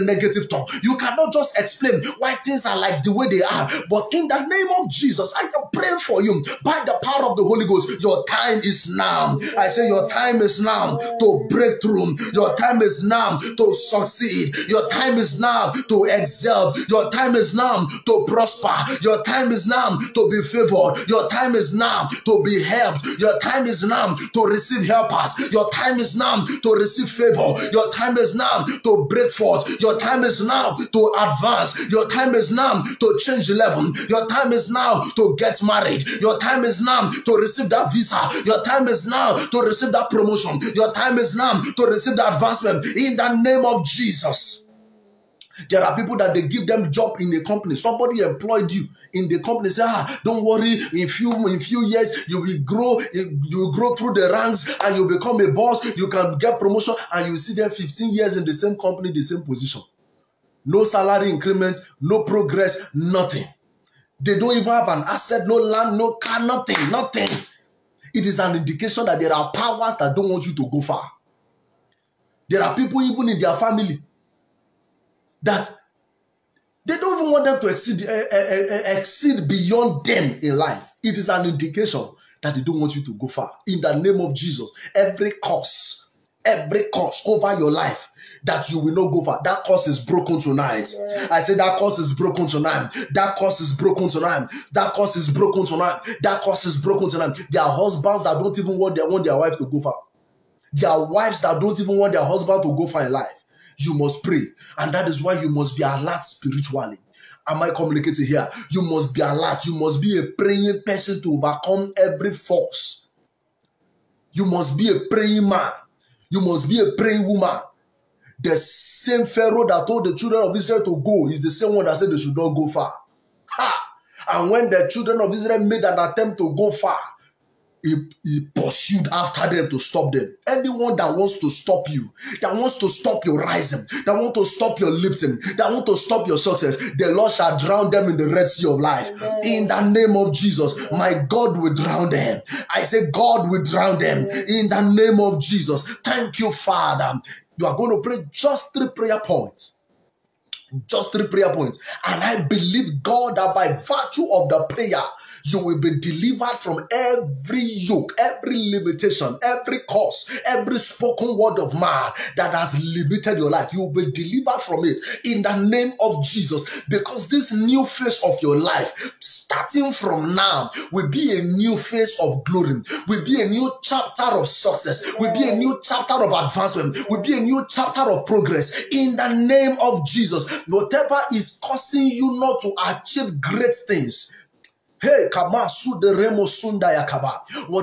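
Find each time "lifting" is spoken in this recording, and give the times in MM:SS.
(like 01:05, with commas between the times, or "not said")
02:14.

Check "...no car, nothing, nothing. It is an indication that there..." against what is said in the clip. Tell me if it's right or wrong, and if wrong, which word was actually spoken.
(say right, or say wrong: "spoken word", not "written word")
right.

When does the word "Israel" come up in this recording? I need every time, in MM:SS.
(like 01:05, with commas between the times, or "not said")
02:00, 02:05.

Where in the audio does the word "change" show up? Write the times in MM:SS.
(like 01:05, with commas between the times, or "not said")
00:33.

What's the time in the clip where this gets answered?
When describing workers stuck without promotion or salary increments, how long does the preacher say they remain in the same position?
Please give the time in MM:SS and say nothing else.
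00:57.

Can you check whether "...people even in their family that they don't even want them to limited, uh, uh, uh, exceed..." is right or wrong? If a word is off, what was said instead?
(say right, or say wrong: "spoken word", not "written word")
wrong: "exceed", not "limited".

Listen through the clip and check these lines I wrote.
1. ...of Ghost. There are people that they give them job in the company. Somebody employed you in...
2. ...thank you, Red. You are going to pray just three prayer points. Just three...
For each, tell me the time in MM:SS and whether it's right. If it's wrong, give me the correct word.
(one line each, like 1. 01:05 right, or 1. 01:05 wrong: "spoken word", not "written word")
1. 00:43 wrong: "Jesus", not "Ghost"
2. 02:26 wrong: "Father", not "Red".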